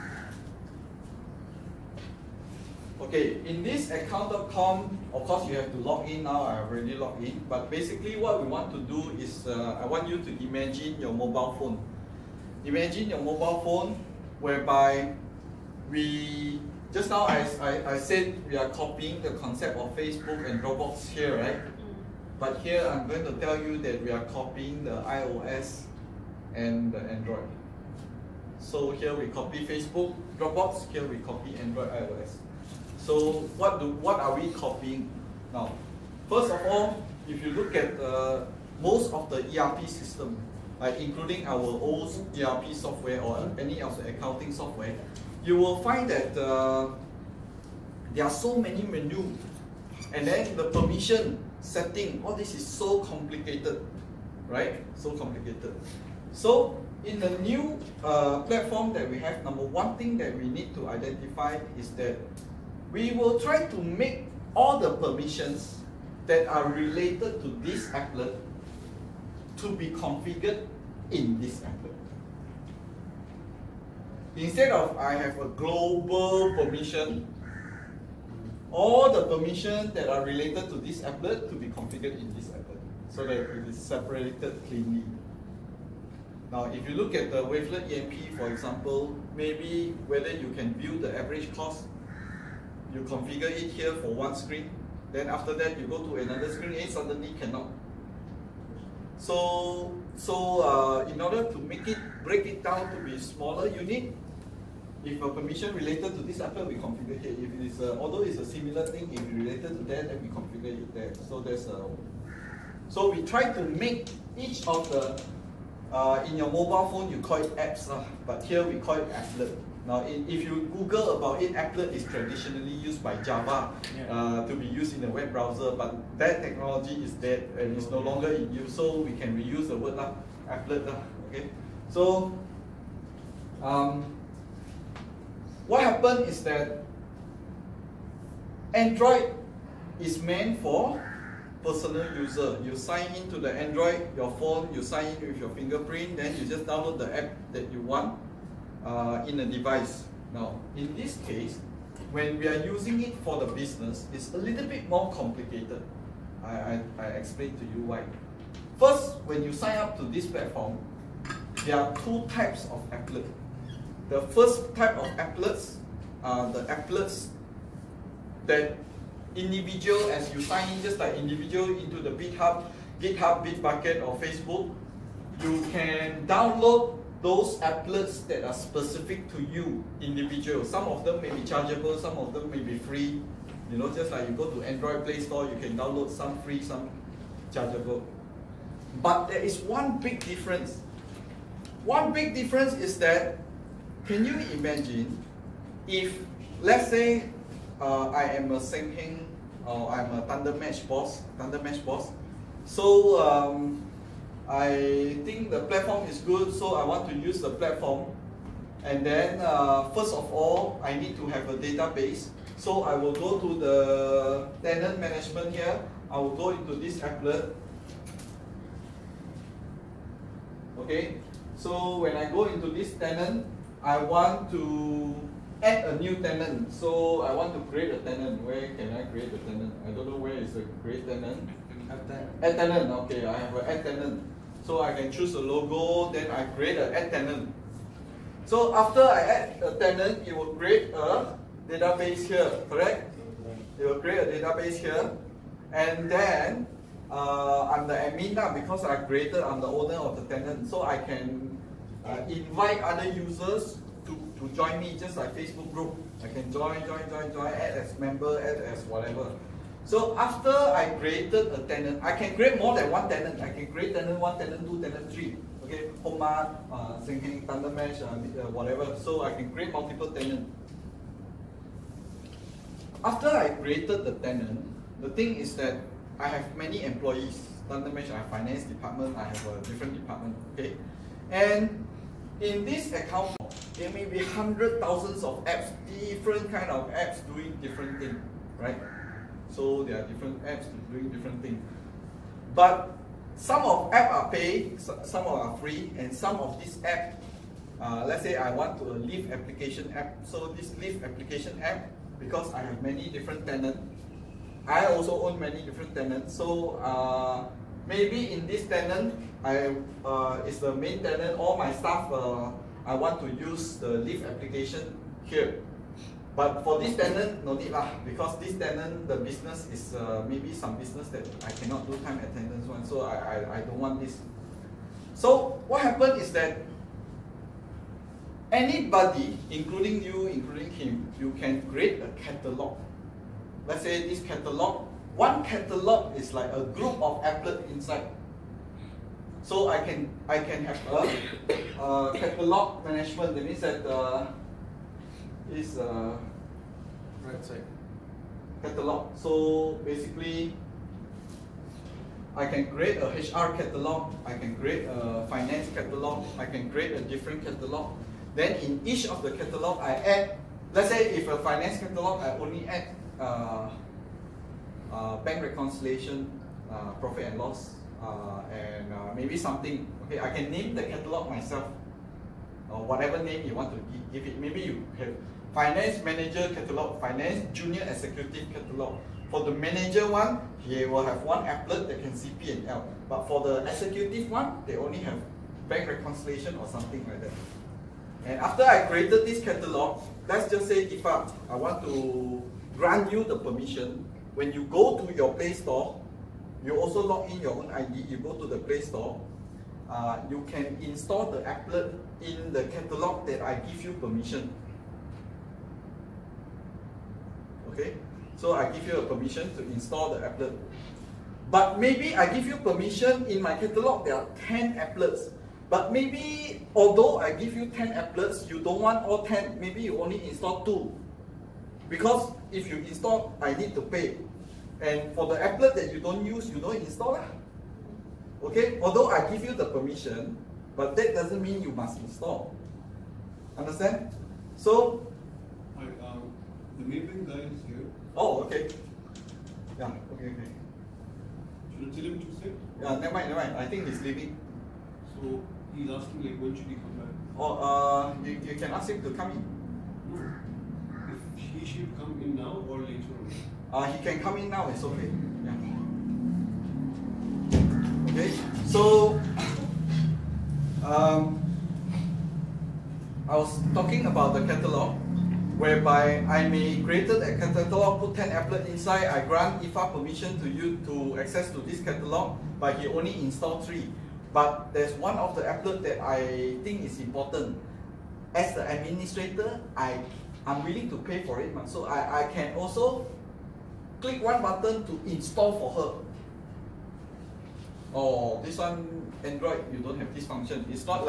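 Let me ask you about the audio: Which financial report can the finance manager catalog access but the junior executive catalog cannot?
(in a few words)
P and L.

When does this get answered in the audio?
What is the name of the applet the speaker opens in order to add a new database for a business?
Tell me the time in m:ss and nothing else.
3:34.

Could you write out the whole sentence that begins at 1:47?
If it is, a, although it's a similar thing, if related to that, then we configure it there.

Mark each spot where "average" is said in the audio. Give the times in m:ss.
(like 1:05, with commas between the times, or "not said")
1:31.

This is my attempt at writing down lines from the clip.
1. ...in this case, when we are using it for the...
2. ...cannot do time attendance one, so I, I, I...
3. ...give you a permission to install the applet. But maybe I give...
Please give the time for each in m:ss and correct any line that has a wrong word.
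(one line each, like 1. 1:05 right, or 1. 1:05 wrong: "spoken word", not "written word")
1. 2:30 right
2. 5:21 right
3. 6:48 right.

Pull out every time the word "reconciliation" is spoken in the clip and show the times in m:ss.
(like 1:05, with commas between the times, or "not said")
6:05, 6:25.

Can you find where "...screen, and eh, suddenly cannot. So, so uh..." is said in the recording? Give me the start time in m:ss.
1:36.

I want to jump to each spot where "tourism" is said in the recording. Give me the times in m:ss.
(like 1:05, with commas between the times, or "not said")
not said.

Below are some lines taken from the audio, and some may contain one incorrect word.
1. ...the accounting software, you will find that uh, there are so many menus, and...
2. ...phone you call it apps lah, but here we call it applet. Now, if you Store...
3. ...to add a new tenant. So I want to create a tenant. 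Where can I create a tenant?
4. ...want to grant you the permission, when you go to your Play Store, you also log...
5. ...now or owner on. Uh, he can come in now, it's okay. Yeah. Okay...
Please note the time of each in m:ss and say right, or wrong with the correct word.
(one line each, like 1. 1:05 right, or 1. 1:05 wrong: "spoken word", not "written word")
1. 0:44 right
2. 1:56 wrong: "Google", not "Store"
3. 3:44 right
4. 6:31 right
5. 7:32 wrong: "later", not "owner".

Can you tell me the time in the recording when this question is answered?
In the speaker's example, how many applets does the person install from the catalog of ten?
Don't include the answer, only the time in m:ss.
7:00.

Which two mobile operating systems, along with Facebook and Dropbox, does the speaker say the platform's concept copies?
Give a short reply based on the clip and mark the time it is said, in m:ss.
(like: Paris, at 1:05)
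Android, iOS, at 0:31.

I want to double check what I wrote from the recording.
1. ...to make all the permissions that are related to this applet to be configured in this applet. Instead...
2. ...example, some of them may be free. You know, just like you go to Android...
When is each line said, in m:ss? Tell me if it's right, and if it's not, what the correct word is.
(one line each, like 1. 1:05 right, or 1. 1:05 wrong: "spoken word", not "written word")
1. 1:03 right
2. 3:01 wrong: "chargeable", not "example".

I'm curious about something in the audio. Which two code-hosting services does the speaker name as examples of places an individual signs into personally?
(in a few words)
GitHub, Bitbucket.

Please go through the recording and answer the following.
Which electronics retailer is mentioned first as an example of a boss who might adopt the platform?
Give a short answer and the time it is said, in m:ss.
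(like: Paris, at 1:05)
Senheng, at 3:18.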